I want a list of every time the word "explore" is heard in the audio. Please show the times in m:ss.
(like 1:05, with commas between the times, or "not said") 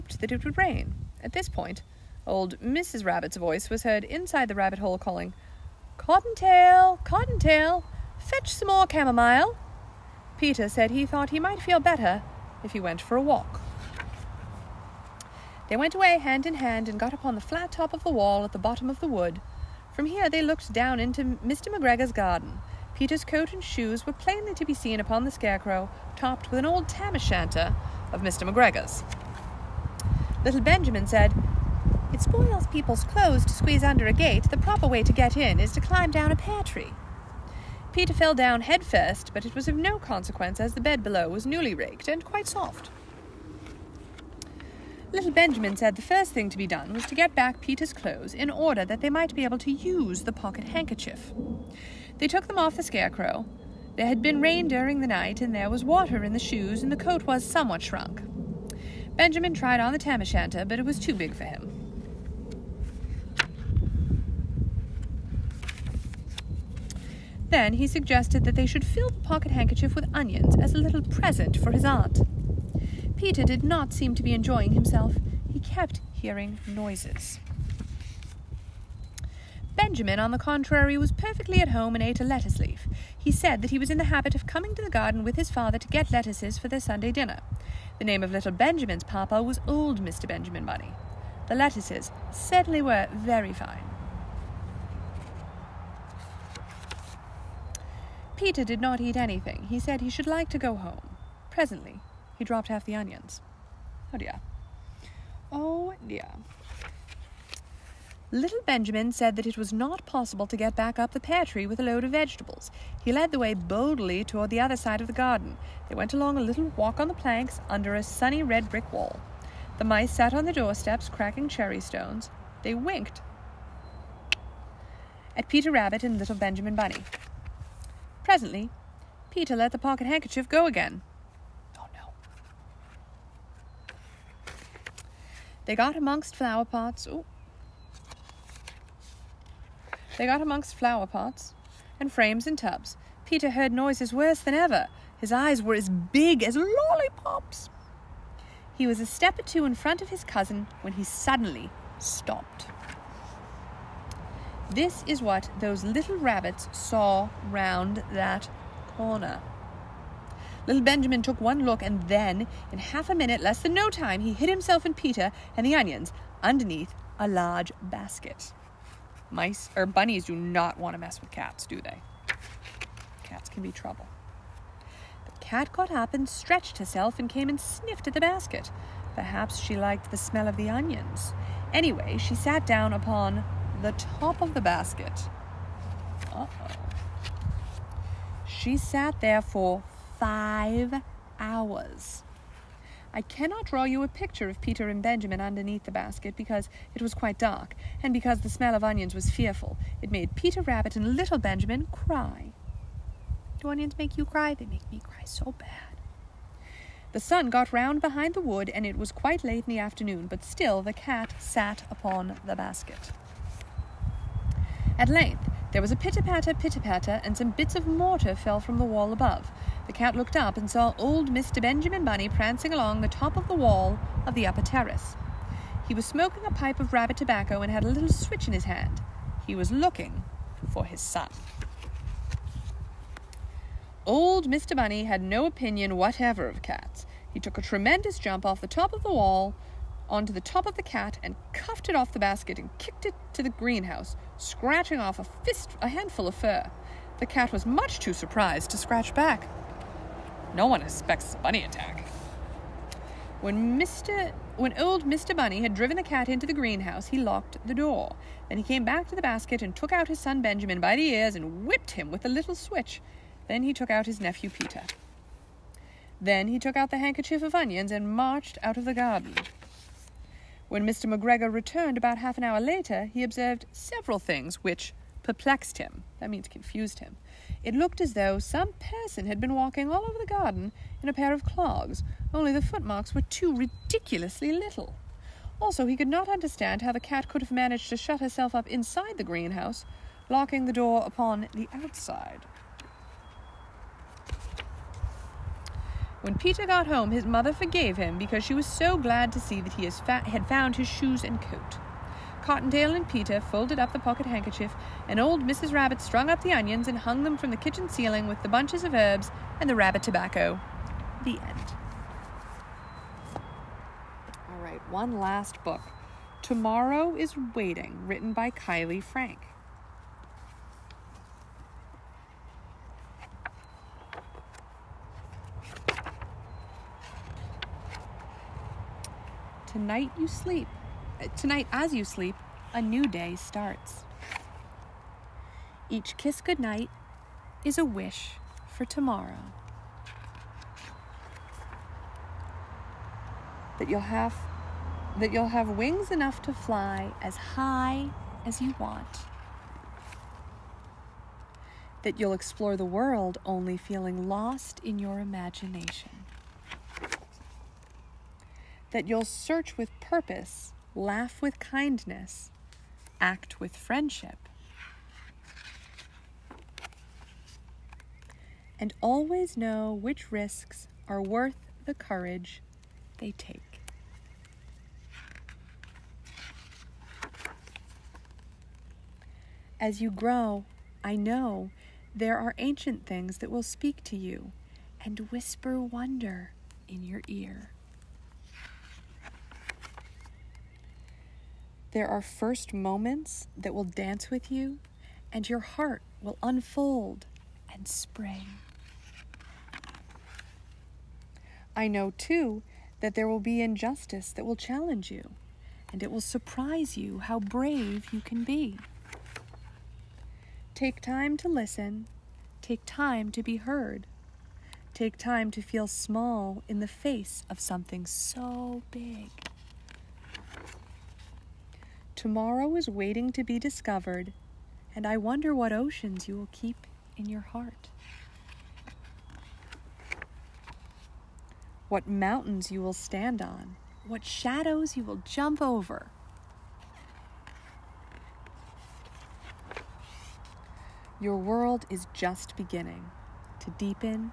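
5:52.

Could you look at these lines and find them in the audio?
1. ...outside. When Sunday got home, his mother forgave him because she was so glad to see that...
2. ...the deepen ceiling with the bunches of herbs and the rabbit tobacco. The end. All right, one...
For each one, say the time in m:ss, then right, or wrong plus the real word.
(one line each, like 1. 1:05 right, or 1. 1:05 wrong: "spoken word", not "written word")
1. 4:51 wrong: "Peter", not "Sunday"
2. 5:07 wrong: "kitchen", not "deepen".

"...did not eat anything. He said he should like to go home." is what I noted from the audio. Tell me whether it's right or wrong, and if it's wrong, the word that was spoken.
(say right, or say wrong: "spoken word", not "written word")
right.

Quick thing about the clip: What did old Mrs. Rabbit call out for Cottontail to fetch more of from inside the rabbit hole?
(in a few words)
chamomile.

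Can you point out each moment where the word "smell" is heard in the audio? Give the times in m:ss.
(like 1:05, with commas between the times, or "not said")
3:00, 3:18.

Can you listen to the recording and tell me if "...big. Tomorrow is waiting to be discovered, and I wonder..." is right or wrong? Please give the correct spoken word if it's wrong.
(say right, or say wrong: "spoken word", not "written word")
right.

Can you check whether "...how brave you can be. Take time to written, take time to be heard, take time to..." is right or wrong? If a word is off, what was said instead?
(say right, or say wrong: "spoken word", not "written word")
wrong: "listen", not "written".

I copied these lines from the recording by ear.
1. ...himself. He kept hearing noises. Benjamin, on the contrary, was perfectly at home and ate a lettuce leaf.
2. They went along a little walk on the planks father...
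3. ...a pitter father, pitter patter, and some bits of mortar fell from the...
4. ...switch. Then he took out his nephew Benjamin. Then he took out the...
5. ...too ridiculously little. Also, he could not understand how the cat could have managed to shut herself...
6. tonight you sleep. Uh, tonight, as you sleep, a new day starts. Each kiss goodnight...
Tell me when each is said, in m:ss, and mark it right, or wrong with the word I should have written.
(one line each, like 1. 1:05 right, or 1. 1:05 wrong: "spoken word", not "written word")
1. 1:14 right
2. 1:55 wrong: "under", not "father"
3. 3:35 wrong: "patter", not "father"
4. 4:22 wrong: "Peter", not "Benjamin"
5. 4:43 right
6. 5:29 right.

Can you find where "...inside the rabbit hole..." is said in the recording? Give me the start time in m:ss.
0:04.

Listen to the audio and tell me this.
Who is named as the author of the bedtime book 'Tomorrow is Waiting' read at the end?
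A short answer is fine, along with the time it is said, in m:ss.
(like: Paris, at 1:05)
Kiley Frank, at 5:18.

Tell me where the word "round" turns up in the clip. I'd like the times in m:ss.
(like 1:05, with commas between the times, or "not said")
2:37, 3:27.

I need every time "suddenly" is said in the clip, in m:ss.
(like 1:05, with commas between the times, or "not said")
2:31.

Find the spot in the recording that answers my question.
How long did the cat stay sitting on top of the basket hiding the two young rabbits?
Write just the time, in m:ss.
3:10.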